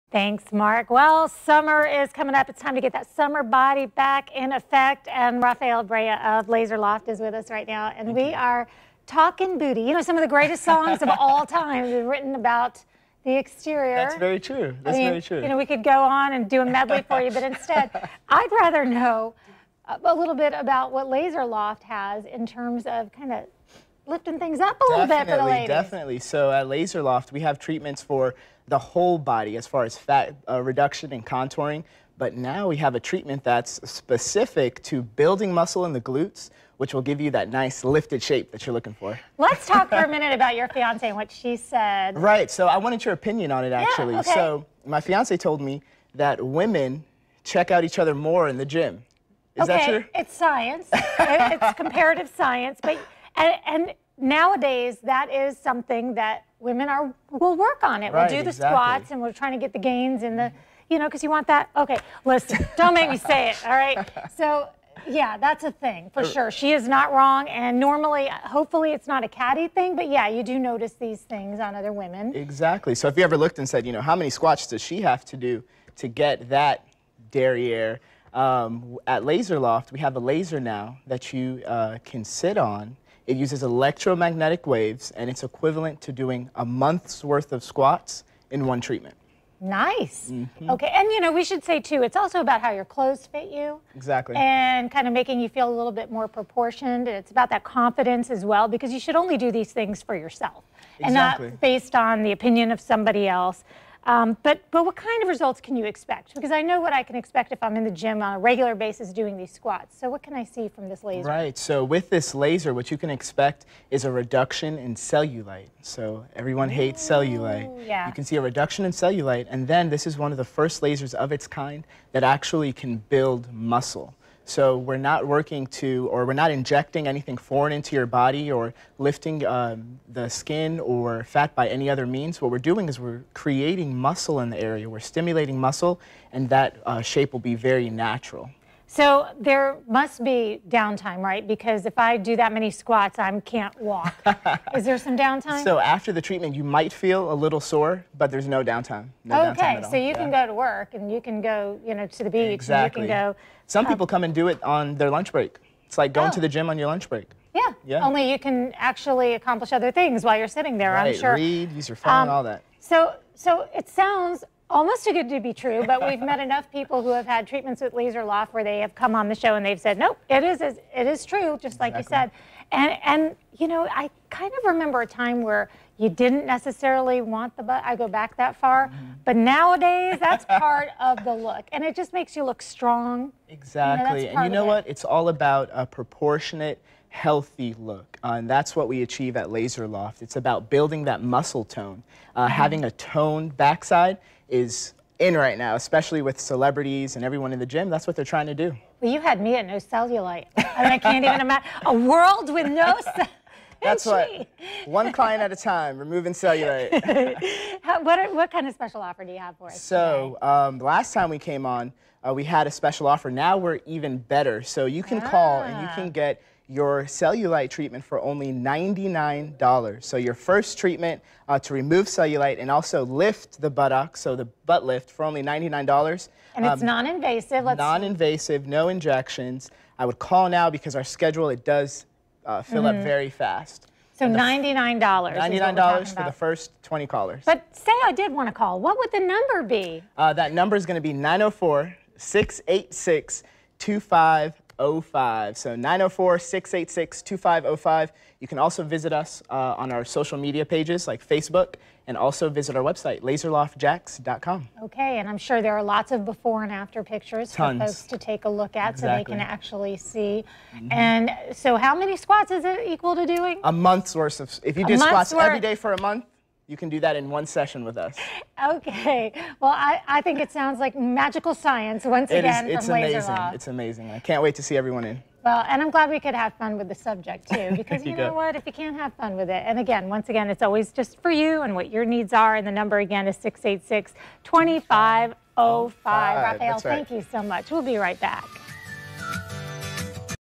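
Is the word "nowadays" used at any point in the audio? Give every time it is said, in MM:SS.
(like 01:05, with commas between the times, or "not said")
00:54, 02:59.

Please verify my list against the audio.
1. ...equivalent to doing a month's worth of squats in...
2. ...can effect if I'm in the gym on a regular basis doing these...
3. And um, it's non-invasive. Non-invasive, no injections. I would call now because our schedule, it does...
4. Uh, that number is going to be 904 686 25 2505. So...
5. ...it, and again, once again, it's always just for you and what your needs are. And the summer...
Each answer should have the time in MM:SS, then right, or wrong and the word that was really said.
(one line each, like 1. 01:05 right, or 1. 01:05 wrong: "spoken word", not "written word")
1. 01:25 right
2. 01:47 wrong: "expect", not "effect"
3. 03:46 right
4. 04:00 right
5. 04:39 wrong: "number", not "summer".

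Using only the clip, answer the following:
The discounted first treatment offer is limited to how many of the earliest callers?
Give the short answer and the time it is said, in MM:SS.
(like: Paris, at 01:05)
20, at 03:56.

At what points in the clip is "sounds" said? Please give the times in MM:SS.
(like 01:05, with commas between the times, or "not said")
02:43, 04:30.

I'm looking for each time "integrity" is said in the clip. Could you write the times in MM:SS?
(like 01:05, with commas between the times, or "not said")
not said.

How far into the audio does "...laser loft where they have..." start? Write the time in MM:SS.
02:47.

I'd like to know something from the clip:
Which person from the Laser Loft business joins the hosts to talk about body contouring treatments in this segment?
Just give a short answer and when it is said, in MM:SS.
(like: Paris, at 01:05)
Rafael Brea, at 00:05.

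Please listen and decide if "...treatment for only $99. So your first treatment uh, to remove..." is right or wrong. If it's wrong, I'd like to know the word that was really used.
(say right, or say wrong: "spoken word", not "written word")
right.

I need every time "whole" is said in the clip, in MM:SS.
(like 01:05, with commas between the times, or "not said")
00:28.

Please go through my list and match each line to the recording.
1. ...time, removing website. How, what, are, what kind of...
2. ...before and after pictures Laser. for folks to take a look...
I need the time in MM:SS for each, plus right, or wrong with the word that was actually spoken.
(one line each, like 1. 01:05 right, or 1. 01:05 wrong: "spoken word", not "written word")
1. 03:25 wrong: "cellulite", not "website"
2. 04:16 wrong: "Tons", not "Laser".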